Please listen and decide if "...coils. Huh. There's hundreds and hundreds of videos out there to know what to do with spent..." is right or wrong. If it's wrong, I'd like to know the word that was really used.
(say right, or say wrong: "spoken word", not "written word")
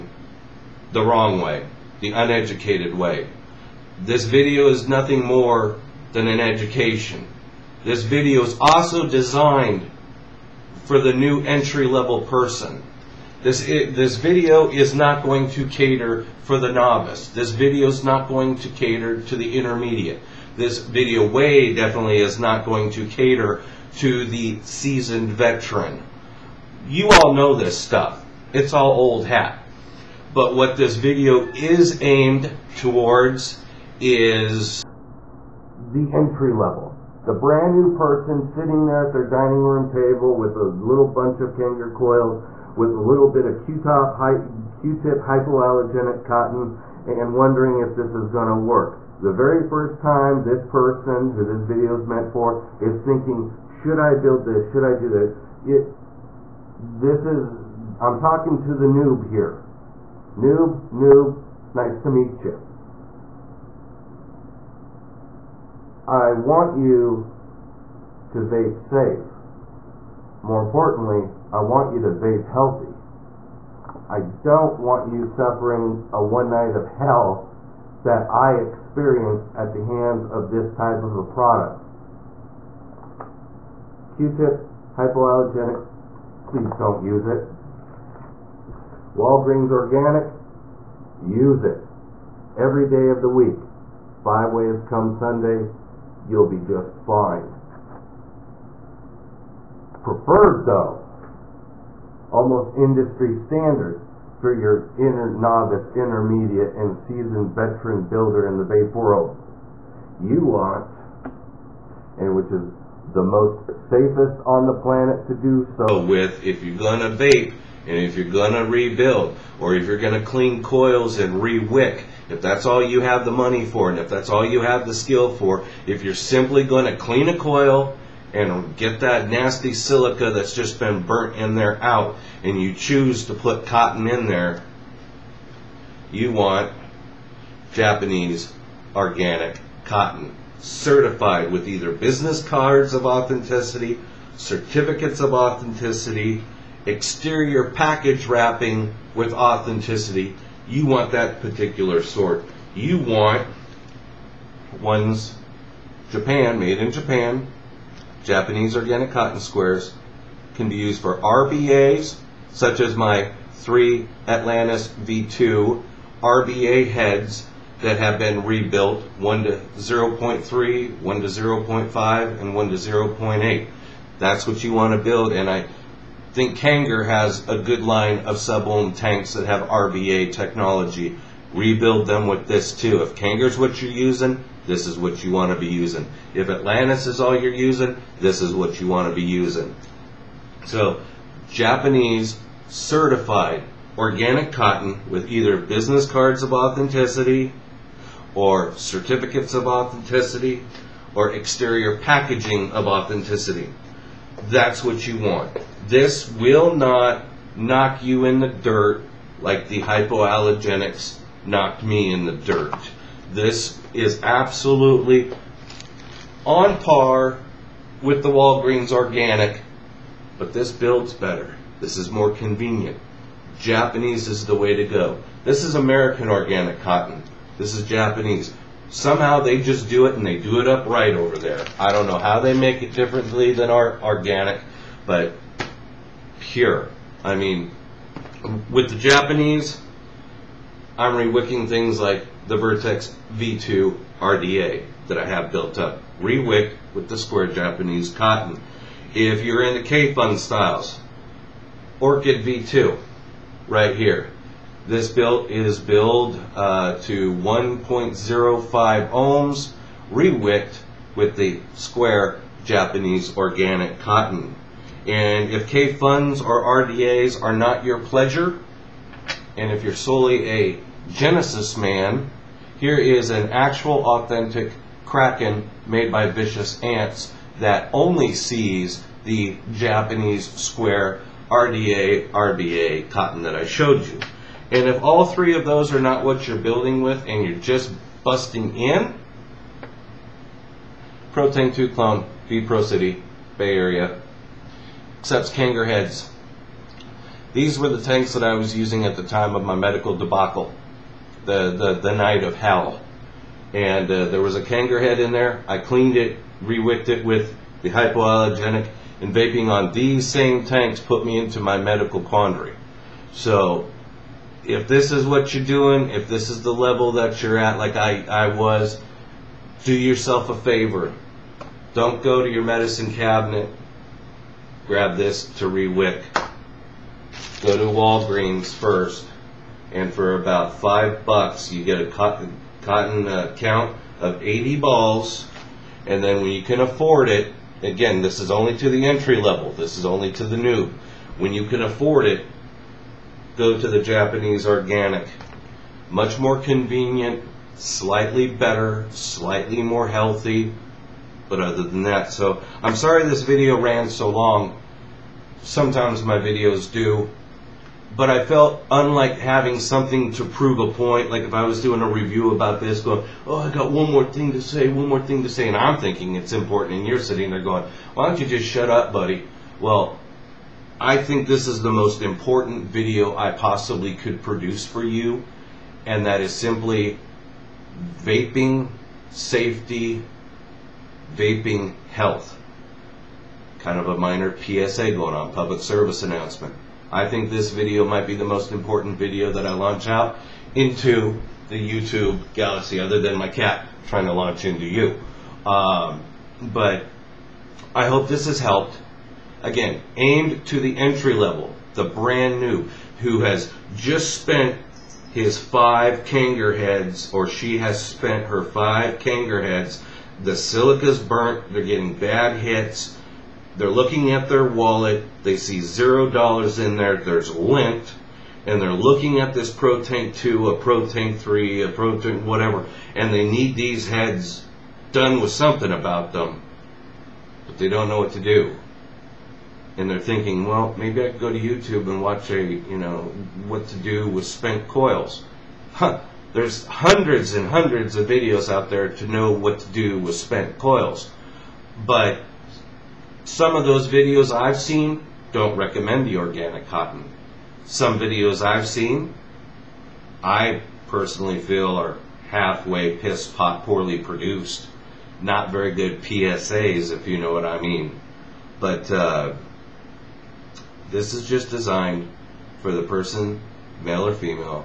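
right.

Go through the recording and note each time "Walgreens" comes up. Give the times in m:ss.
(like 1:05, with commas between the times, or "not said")
1:29, 3:38, 5:27.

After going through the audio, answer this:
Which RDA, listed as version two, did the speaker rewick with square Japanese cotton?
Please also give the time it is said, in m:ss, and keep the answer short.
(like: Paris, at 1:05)
Vertex V2, at 4:02.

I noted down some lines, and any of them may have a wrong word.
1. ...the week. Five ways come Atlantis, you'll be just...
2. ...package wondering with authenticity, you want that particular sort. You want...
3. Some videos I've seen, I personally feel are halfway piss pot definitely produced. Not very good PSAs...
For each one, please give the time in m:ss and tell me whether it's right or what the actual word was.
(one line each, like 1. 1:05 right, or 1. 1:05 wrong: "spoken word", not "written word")
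1. 1:33 wrong: "Sunday", not "Atlantis"
2. 2:27 wrong: "wrapping", not "wondering"
3. 7:27 wrong: "poorly", not "definitely".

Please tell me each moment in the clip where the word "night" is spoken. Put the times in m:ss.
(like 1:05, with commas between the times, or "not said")
1:16, 5:02.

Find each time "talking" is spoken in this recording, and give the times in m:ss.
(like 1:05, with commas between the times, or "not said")
0:58.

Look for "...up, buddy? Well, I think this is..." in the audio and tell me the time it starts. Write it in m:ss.
6:08.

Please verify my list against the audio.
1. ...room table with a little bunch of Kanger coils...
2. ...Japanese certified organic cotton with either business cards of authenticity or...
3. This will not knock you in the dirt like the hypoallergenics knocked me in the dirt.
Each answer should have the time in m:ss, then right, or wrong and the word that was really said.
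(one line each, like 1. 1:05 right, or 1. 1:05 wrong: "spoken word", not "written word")
1. 0:39 right
2. 3:11 right
3. 3:25 right.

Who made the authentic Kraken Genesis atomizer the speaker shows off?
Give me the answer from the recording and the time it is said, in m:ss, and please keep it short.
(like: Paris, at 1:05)
Vicious Ants, at 4:36.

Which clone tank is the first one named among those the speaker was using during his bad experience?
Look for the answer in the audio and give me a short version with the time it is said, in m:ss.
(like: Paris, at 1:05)
ProTank 2, at 4:51.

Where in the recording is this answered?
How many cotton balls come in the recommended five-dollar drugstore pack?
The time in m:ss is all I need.
5:34.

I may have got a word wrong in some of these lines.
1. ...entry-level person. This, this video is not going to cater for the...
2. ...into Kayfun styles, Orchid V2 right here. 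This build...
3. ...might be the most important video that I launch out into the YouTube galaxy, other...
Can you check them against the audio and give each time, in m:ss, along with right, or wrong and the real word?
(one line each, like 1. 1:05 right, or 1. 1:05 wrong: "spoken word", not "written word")
1. 0:11 right
2. 4:09 right
3. 6:28 right.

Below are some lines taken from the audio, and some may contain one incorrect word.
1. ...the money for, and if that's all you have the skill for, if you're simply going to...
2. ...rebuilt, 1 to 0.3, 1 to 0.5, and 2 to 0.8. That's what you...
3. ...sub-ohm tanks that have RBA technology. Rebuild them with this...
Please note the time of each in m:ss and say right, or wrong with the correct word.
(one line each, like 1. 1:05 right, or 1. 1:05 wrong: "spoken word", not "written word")
1. 2:03 right
2. 2:48 wrong: "1", not "2"
3. 2:58 right.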